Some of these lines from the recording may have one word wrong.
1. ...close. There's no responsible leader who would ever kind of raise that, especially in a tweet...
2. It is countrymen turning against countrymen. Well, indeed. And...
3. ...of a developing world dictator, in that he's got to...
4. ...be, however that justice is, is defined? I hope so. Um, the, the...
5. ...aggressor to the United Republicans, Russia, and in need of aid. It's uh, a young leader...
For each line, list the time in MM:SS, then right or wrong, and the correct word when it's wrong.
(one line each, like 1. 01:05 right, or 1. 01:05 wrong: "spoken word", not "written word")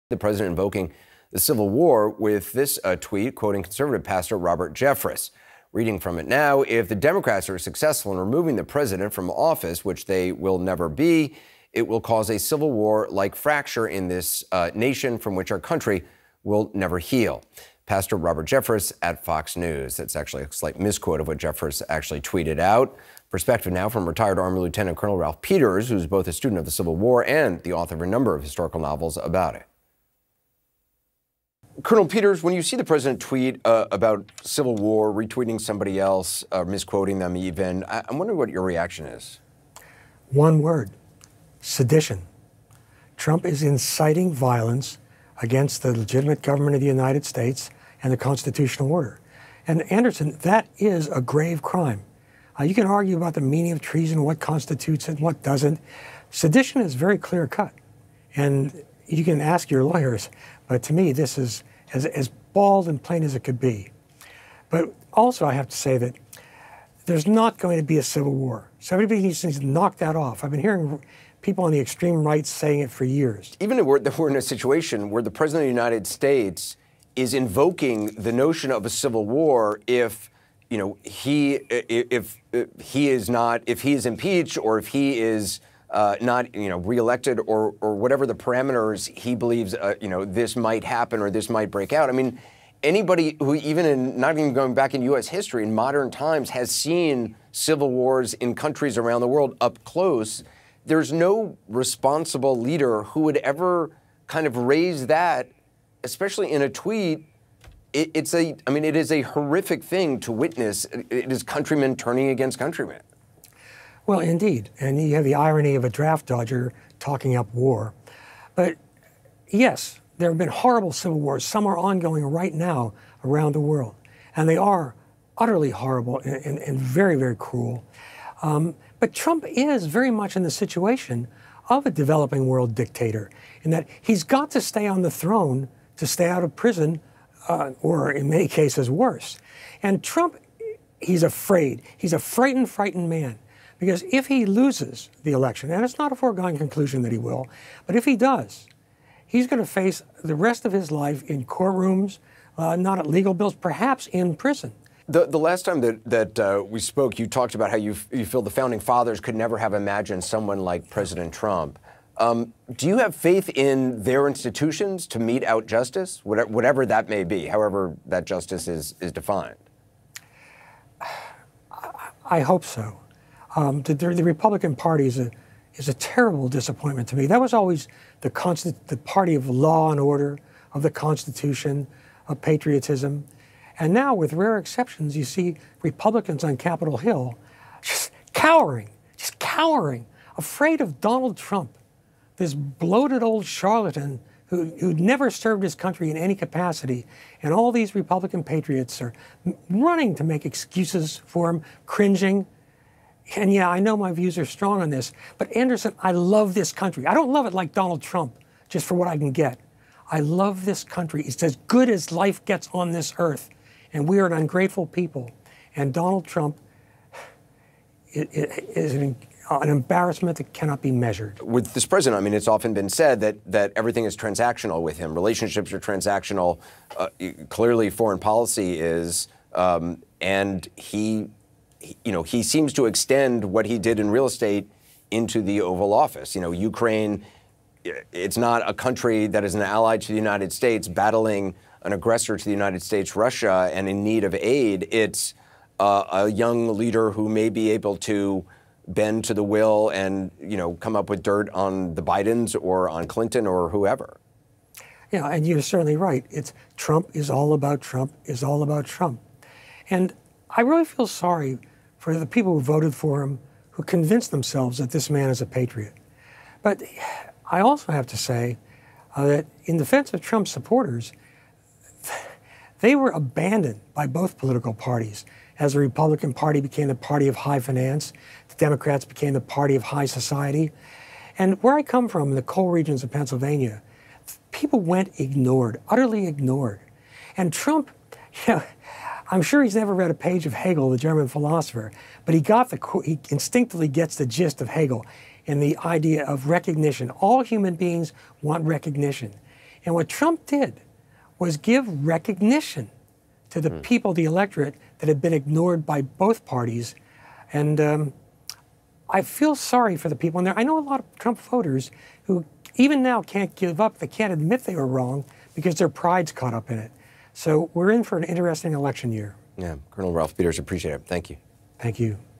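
1. 01:39 right
2. 01:50 right
3. 02:11 right
4. 02:47 right
5. 04:01 wrong: "States", not "Republicans".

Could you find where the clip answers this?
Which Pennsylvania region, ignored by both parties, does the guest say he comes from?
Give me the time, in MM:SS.
04:42.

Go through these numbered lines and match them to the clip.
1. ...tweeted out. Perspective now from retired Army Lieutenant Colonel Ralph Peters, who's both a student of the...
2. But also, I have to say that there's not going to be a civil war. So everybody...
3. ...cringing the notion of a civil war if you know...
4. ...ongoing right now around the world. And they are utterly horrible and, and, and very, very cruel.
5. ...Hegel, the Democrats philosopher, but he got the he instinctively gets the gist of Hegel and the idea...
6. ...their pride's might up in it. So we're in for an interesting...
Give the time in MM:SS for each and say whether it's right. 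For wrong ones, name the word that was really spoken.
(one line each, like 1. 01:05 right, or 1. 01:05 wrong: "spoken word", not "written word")
1. 00:22 right
2. 01:04 right
3. 01:17 wrong: "invoking", not "cringing"
4. 02:01 right
5. 04:50 wrong: "German", not "Democrats"
6. 05:15 wrong: "caught", not "might".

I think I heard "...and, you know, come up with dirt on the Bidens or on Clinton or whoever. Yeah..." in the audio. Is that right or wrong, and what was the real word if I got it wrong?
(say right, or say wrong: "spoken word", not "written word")
right.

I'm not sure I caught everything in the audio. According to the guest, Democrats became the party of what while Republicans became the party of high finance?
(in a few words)
High society.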